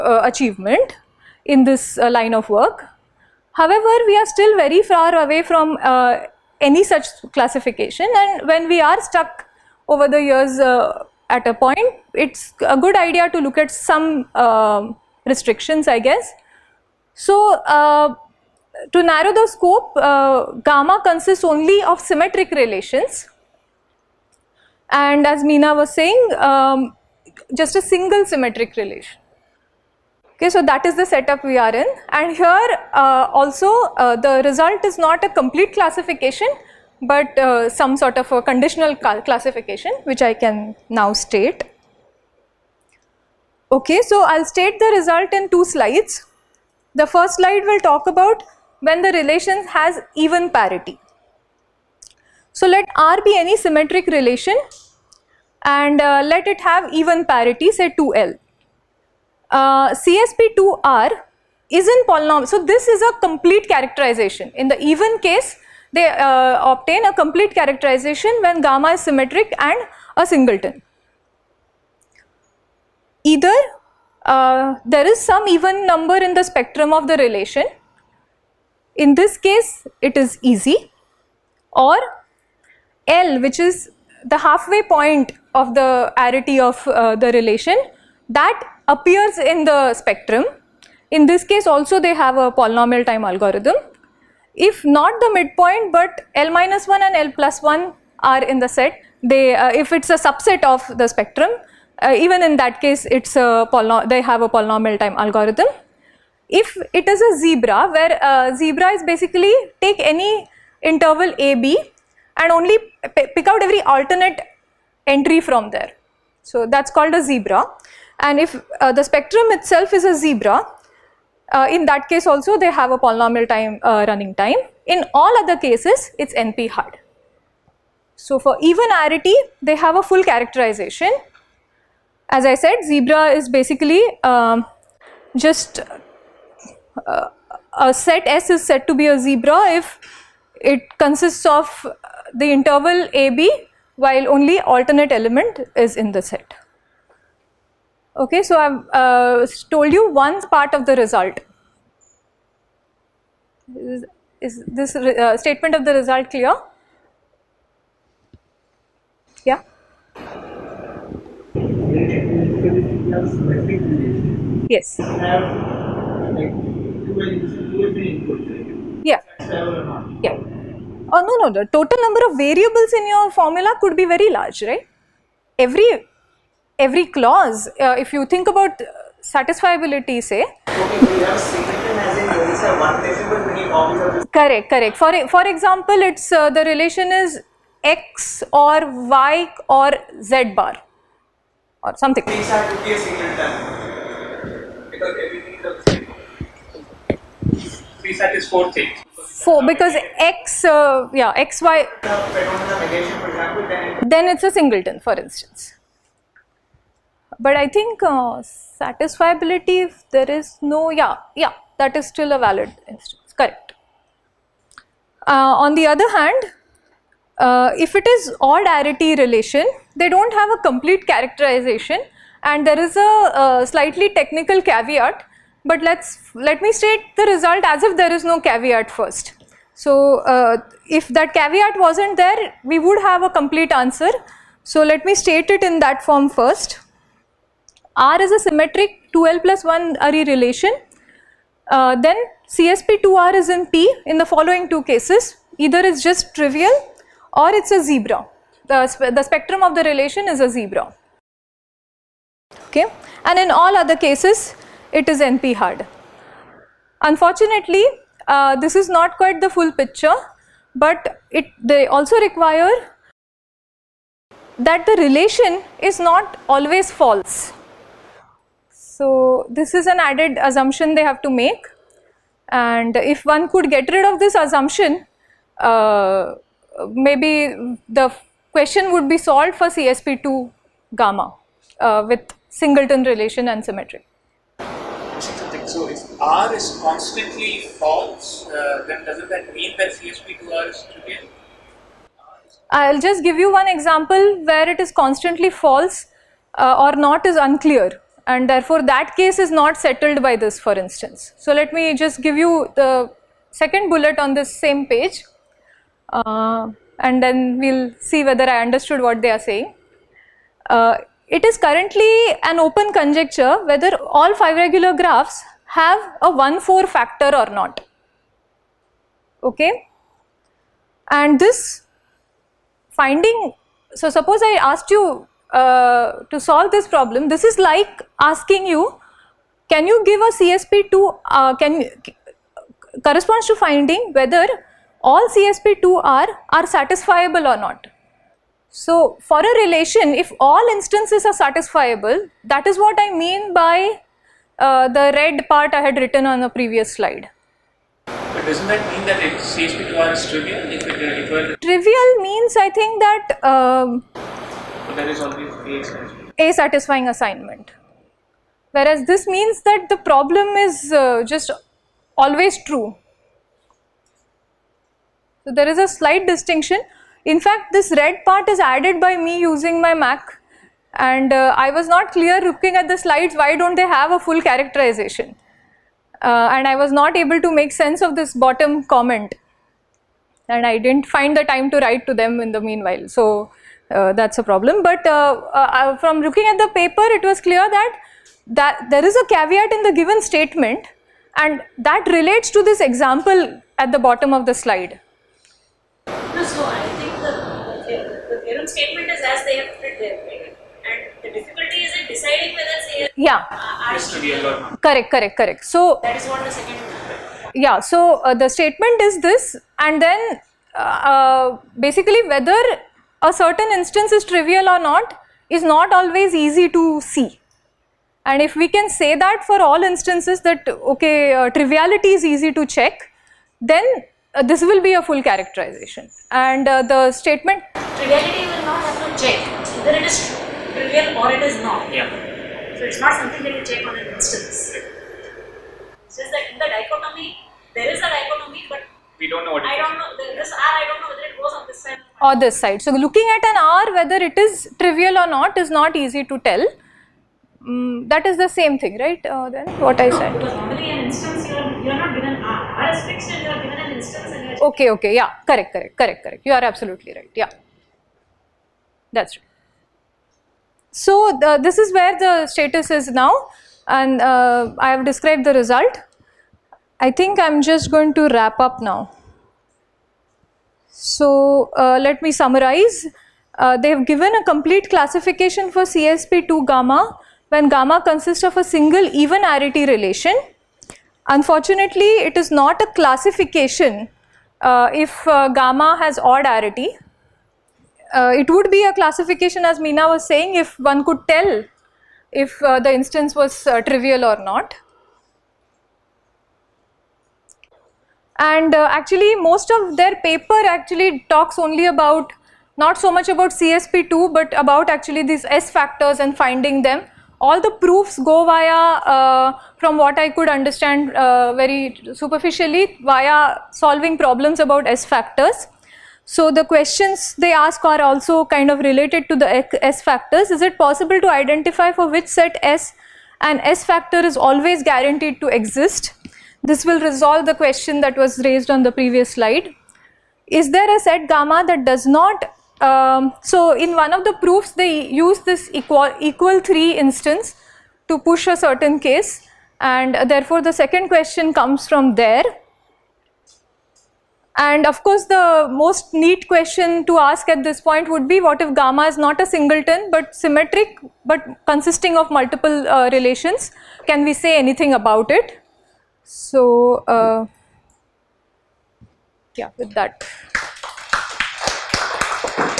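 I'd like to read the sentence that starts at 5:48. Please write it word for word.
But doesn't that mean that it CHP requires trivial?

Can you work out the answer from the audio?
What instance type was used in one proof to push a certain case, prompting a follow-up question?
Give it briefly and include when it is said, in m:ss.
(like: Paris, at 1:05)
equal, equal 3, at 8:55.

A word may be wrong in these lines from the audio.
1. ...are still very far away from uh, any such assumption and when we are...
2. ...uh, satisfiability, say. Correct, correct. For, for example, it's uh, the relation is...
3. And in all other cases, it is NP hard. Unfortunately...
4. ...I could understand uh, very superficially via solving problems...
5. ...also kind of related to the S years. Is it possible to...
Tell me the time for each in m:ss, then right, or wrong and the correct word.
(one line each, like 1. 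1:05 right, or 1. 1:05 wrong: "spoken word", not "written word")
1. 0:04 wrong: "classification", not "assumption"
2. 2:58 right
3. 4:13 right
4. 8:30 right
5. 8:38 wrong: "factors", not "years".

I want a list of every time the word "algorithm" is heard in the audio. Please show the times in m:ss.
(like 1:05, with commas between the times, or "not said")
1:33, 1:45.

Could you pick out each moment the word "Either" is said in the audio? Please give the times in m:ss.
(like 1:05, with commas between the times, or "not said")
1:13, 4:05.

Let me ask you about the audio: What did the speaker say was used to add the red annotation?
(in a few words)
Mac.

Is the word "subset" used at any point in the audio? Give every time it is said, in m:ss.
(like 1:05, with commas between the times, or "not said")
1:40.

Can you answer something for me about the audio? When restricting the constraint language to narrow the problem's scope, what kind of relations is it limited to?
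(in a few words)
symmetric relations.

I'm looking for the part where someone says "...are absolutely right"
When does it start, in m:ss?
7:36.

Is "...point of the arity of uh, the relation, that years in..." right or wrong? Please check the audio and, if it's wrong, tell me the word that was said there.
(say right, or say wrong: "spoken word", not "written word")
wrong: "appears", not "years".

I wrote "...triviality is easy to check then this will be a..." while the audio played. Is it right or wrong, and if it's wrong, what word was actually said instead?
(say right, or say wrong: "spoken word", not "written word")
right.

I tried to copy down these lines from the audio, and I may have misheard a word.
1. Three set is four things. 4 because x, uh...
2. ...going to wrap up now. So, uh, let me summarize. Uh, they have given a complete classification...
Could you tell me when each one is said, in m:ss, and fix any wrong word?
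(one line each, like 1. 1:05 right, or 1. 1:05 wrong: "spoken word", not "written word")
1. 3:18 right
2. 7:47 right.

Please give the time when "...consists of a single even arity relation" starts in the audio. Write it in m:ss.
7:58.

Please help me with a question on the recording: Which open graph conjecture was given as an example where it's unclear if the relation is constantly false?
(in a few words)
all five regular graphs have a one-four factor.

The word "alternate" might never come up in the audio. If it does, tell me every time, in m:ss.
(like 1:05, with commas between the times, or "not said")
1:53, 2:24.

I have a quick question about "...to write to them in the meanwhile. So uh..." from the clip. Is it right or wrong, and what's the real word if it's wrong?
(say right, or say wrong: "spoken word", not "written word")
right.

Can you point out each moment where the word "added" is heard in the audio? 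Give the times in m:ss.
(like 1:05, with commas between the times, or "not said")
4:30, 6:08.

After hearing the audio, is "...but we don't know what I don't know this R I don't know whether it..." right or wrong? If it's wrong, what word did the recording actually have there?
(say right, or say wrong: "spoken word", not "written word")
right.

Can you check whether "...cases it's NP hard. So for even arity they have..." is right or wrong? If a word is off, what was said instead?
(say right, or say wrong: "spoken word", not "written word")
right.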